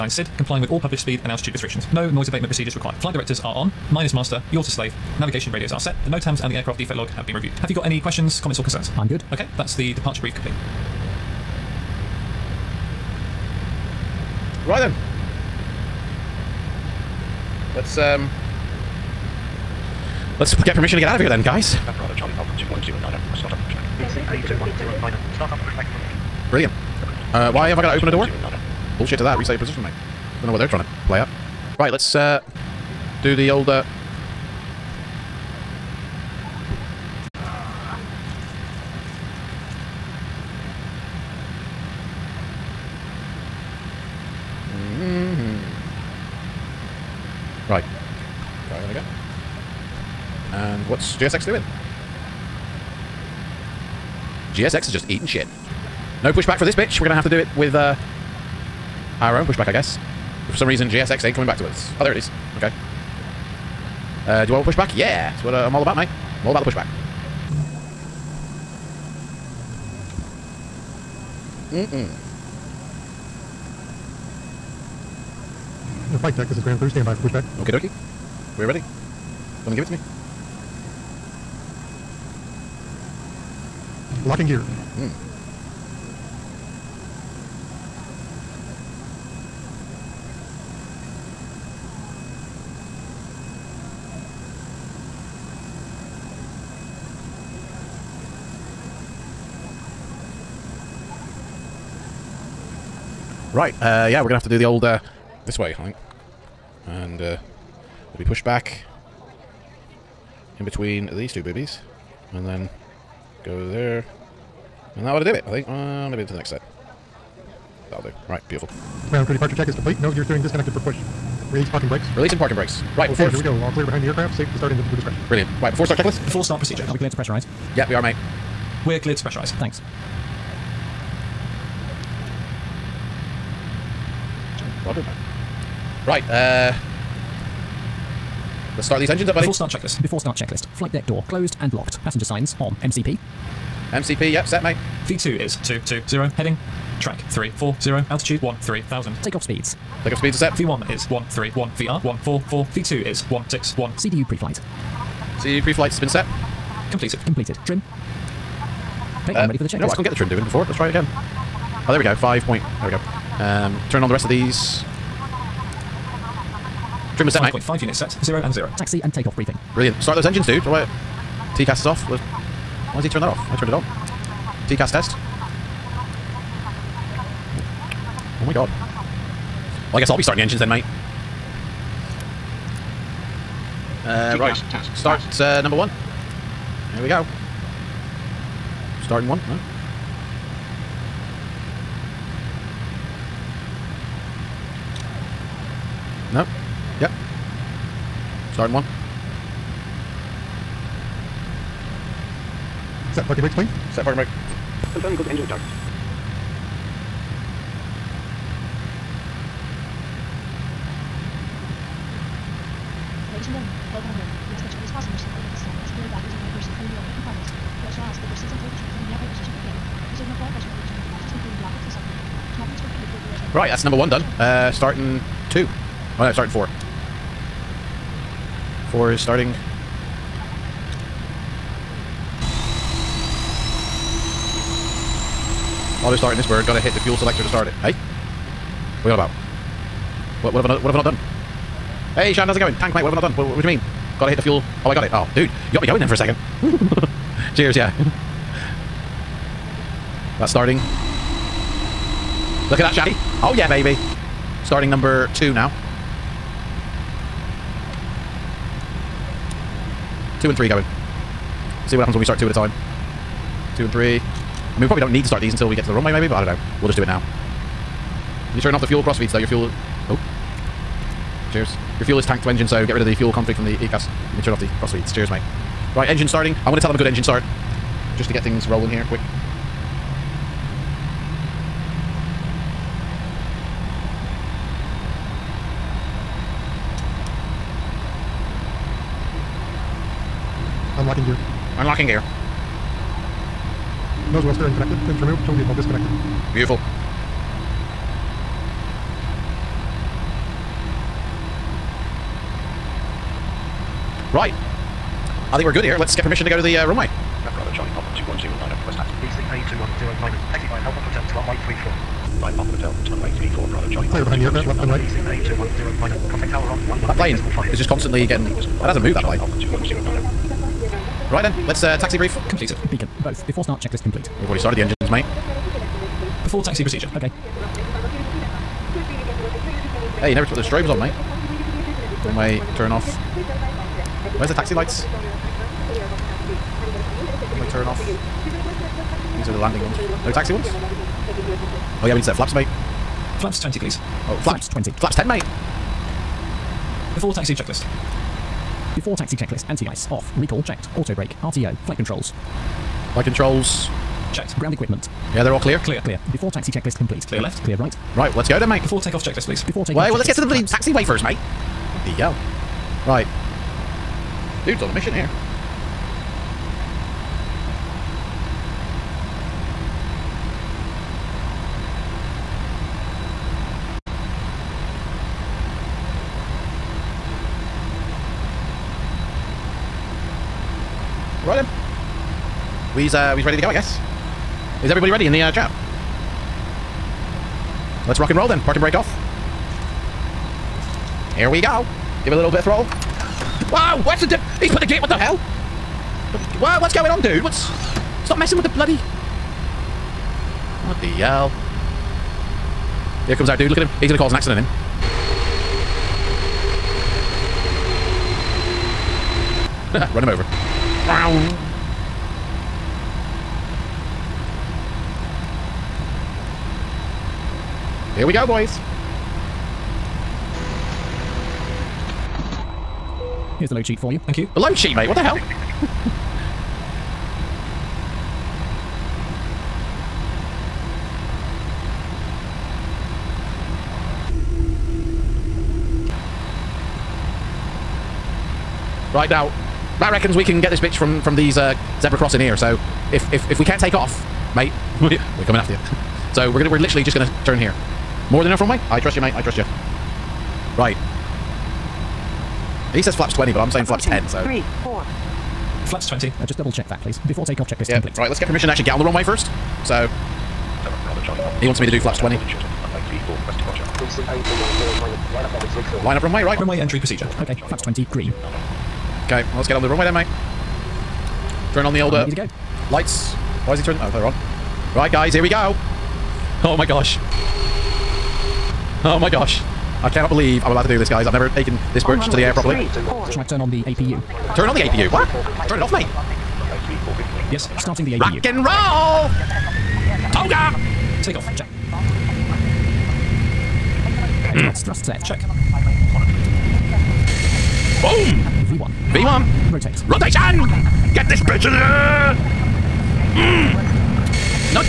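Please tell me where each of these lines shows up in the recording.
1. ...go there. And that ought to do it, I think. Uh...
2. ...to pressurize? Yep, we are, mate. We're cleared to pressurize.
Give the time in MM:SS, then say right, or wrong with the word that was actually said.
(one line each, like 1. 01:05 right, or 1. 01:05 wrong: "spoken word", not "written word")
1. 01:53 right
2. 02:07 right.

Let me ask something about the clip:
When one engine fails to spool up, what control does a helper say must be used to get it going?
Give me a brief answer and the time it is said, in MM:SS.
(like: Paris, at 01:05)
Fuel selector, at 03:57.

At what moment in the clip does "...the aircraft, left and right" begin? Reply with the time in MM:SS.
05:14.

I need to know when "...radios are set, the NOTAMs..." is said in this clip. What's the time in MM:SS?
00:05.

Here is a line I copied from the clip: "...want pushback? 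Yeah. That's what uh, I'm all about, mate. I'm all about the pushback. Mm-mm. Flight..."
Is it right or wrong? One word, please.
right.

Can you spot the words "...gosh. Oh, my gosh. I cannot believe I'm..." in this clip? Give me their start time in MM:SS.
07:56.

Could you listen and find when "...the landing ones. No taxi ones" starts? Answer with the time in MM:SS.
05:39.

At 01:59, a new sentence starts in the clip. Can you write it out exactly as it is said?
Ground crew departure check is complete.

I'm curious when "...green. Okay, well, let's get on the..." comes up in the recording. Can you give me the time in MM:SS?
07:48.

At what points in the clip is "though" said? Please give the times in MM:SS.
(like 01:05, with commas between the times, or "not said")
04:29.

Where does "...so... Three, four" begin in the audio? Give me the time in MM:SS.
07:34.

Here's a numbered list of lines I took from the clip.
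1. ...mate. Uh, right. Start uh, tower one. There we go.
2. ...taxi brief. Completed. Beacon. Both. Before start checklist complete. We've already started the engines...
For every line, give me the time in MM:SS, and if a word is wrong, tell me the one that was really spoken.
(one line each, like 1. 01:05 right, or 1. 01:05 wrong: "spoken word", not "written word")
1. 03:00 wrong: "number", not "tower"
2. 05:21 right.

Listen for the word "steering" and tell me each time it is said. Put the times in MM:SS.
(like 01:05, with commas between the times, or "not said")
02:00, 04:54.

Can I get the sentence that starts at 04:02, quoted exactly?
Tank, mate, what have I not done?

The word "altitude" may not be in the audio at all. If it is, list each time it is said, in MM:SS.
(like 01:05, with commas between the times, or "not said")
00:01, 02:28.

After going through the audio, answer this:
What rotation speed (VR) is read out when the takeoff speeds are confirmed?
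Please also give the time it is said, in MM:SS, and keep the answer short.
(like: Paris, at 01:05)
144, at 02:31.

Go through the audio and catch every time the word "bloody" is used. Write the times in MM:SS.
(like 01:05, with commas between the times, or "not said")
06:00, 06:38.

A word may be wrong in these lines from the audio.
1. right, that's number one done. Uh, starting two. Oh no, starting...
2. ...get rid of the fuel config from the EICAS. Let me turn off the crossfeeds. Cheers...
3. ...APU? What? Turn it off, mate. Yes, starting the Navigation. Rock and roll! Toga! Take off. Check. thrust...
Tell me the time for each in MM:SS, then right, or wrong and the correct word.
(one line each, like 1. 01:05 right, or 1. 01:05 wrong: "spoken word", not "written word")
1. 03:43 right
2. 04:32 right
3. 08:04 wrong: "APU", not "Navigation".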